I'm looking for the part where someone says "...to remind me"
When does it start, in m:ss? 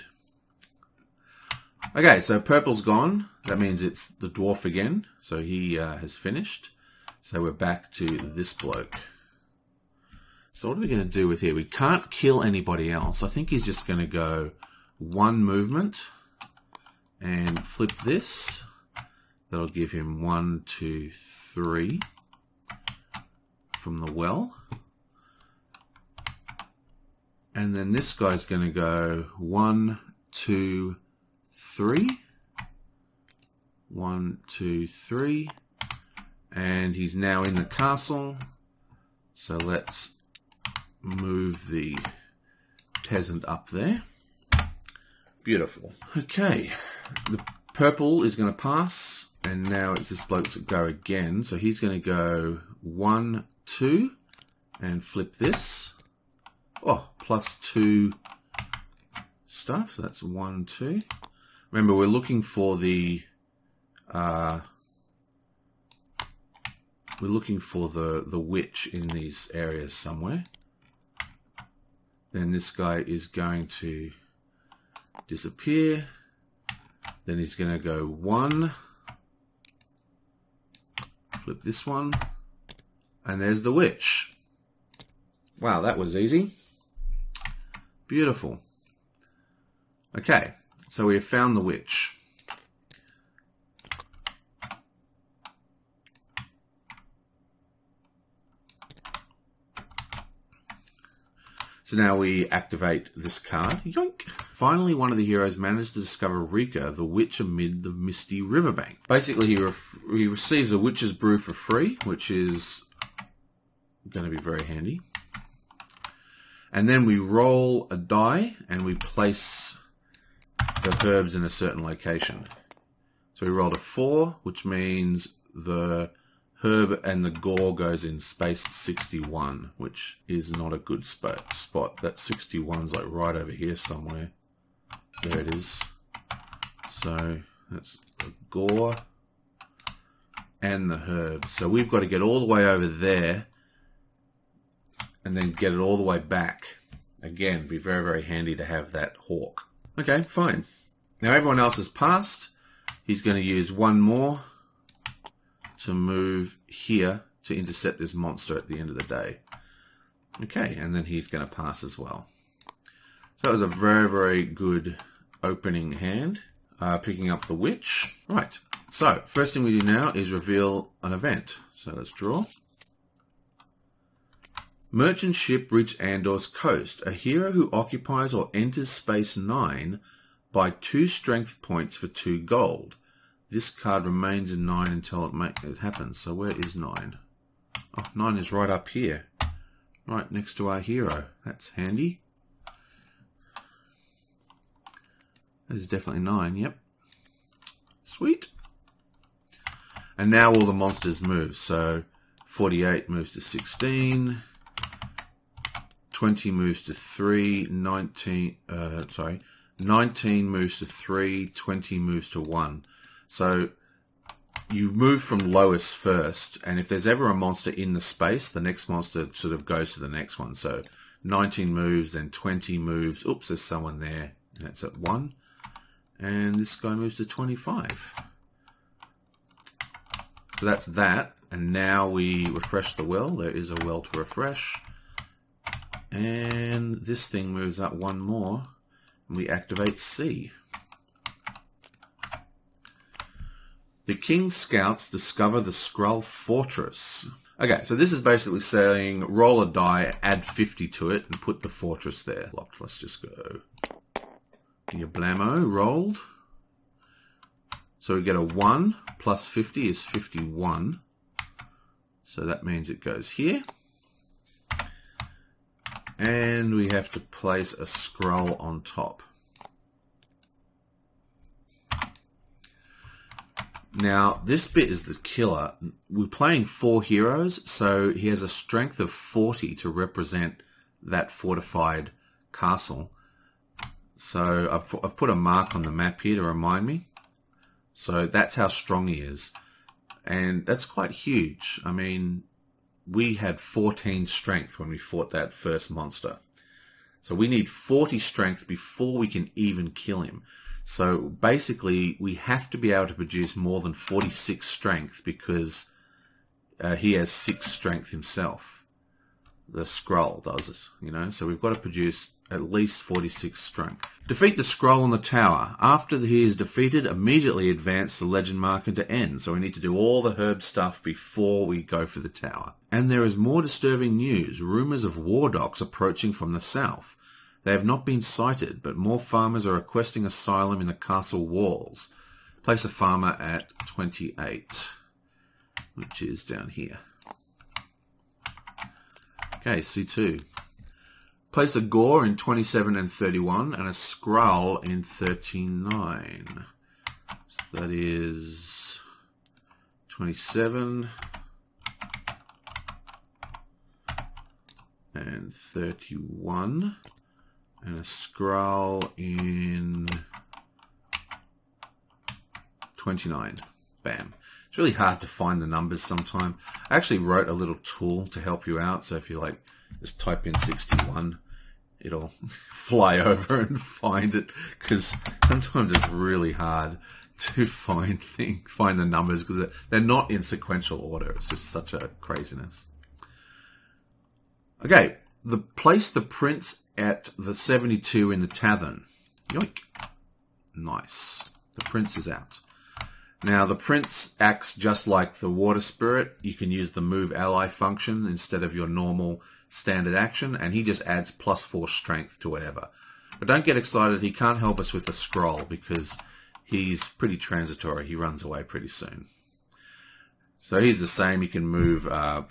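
4:46.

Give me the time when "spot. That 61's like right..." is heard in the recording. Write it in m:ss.
2:11.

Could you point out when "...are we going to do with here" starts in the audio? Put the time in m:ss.
0:10.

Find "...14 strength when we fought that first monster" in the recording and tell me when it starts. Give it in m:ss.
4:53.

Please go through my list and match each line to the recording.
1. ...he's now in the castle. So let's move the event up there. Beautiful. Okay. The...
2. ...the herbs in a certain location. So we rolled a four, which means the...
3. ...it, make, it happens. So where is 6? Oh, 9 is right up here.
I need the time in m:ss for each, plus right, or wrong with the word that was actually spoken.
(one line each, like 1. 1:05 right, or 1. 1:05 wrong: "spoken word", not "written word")
1. 0:36 wrong: "peasant", not "event"
2. 2:00 right
3. 3:05 wrong: "9", not "6".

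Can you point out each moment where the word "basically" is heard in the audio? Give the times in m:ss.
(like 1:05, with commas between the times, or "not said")
1:49, 4:08, 5:01.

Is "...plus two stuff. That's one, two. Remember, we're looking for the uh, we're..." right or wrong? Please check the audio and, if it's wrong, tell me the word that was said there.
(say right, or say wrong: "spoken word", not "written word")
right.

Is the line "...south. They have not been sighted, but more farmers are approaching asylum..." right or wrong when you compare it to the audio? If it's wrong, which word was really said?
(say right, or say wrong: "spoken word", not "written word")
wrong: "requesting", not "approaching".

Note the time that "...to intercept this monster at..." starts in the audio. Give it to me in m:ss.
2:37.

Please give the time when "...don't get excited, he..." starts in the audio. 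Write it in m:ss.
6:43.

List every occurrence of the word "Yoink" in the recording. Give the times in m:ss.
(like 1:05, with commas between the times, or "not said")
1:43, 6:29.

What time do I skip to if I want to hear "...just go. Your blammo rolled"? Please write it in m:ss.
4:12.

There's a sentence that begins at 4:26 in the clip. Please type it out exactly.
And we have to place a scroll on top.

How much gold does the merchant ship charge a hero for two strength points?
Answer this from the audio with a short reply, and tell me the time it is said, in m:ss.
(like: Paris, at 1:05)
2 gold, at 3:02.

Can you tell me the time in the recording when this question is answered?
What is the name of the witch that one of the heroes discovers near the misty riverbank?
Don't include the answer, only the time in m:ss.
1:46.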